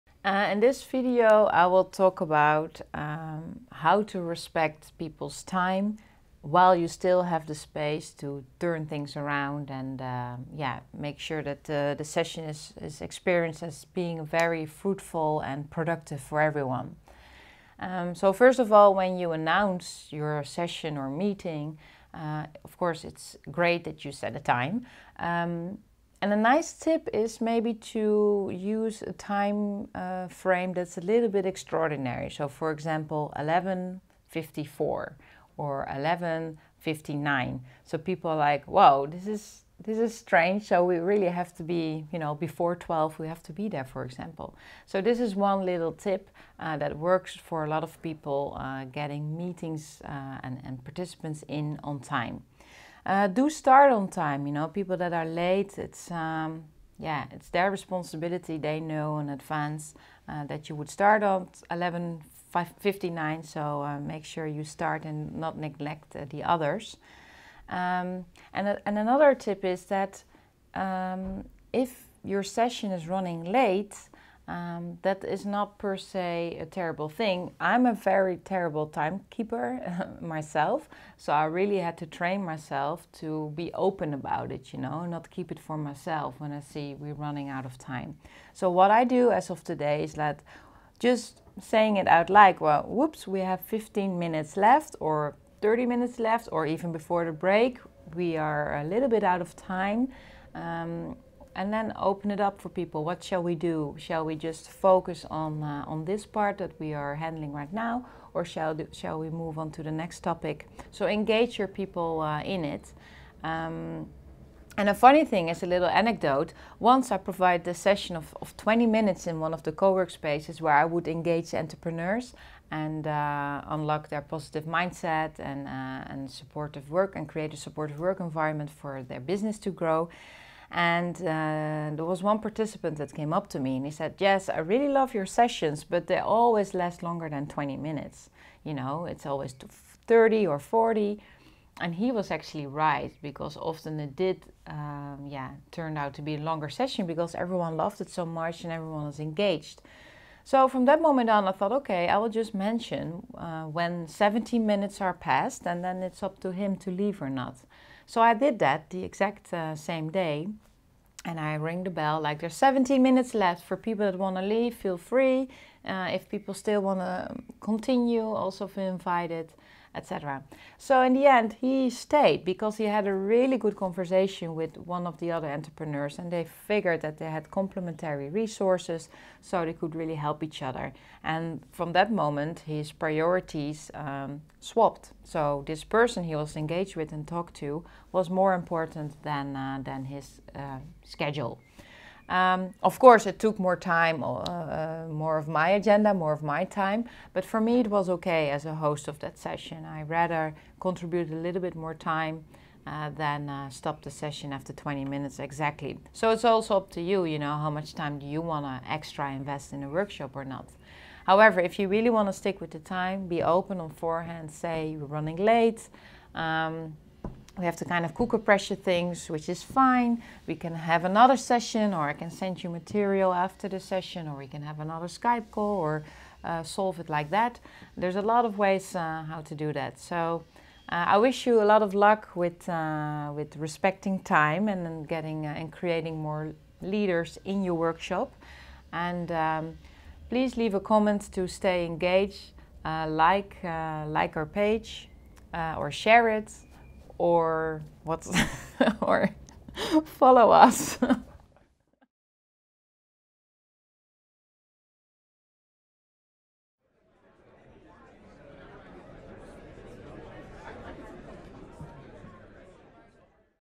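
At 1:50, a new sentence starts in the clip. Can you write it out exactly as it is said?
So engage your people uh, in it.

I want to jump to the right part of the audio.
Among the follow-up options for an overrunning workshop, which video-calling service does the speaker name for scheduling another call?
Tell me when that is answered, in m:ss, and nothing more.
3:45.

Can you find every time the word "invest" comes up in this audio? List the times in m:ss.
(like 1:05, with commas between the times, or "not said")
3:29.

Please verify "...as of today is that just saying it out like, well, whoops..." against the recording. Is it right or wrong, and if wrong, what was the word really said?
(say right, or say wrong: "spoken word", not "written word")
right.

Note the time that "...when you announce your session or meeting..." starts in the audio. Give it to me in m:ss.
0:18.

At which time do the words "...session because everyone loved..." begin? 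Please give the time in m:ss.
2:26.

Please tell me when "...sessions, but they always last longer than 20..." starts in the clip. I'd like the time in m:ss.
2:15.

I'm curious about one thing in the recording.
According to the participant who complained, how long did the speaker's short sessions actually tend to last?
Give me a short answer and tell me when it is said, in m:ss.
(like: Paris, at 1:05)
40 minutes, at 2:20.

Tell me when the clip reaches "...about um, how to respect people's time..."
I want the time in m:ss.
0:02.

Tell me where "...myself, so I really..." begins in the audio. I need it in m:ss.
1:20.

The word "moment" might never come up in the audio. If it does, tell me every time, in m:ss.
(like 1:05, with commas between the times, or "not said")
2:31, 3:02.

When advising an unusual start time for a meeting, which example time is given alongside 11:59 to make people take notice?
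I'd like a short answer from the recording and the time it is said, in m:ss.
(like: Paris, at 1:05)
11:54, at 0:33.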